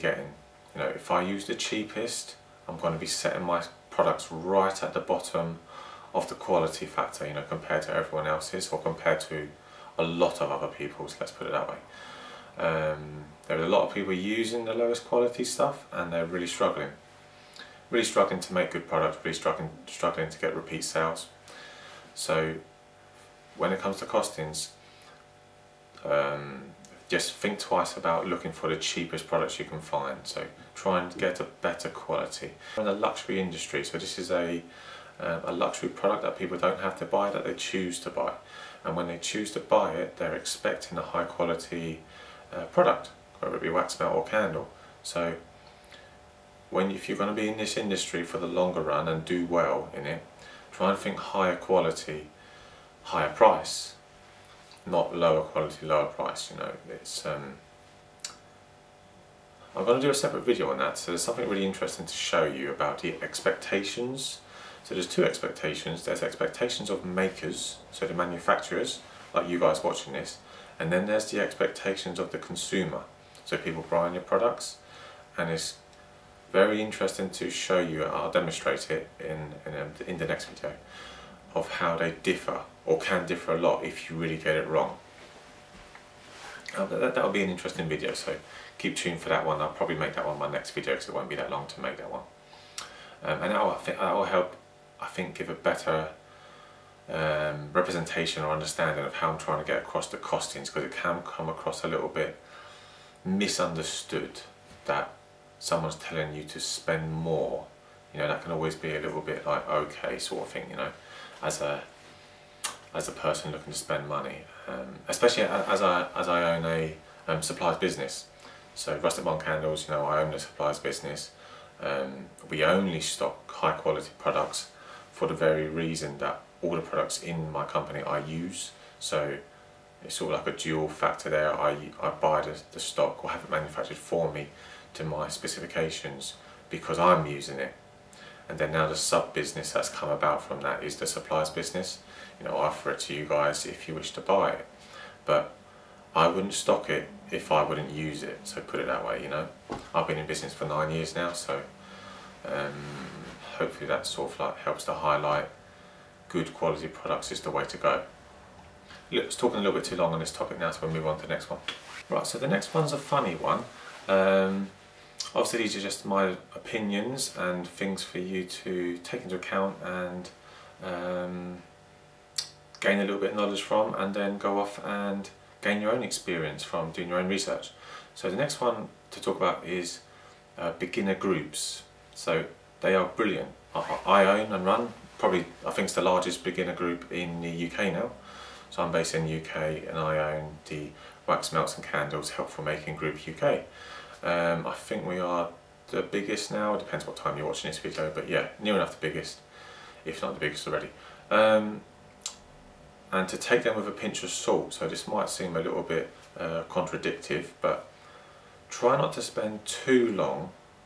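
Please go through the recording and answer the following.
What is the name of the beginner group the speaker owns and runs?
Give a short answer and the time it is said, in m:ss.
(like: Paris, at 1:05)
Wax Melts and Candles Helpful Making Group UK, at 3:11.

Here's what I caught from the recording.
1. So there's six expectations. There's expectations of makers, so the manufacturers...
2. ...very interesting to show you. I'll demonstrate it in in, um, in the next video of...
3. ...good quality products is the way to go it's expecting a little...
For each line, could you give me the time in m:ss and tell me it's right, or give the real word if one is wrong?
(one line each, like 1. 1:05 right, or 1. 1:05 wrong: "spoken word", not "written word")
1. 1:04 wrong: "two", not "six"
2. 1:16 right
3. 2:36 wrong: "talking", not "expecting".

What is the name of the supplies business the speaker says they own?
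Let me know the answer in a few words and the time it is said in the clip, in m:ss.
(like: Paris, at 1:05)
Rustic Barn Candles, at 1:58.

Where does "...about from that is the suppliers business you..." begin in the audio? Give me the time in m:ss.
2:20.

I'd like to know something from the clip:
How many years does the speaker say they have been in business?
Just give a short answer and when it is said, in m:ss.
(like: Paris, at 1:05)
9, at 2:30.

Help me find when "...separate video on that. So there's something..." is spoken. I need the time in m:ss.
1:00.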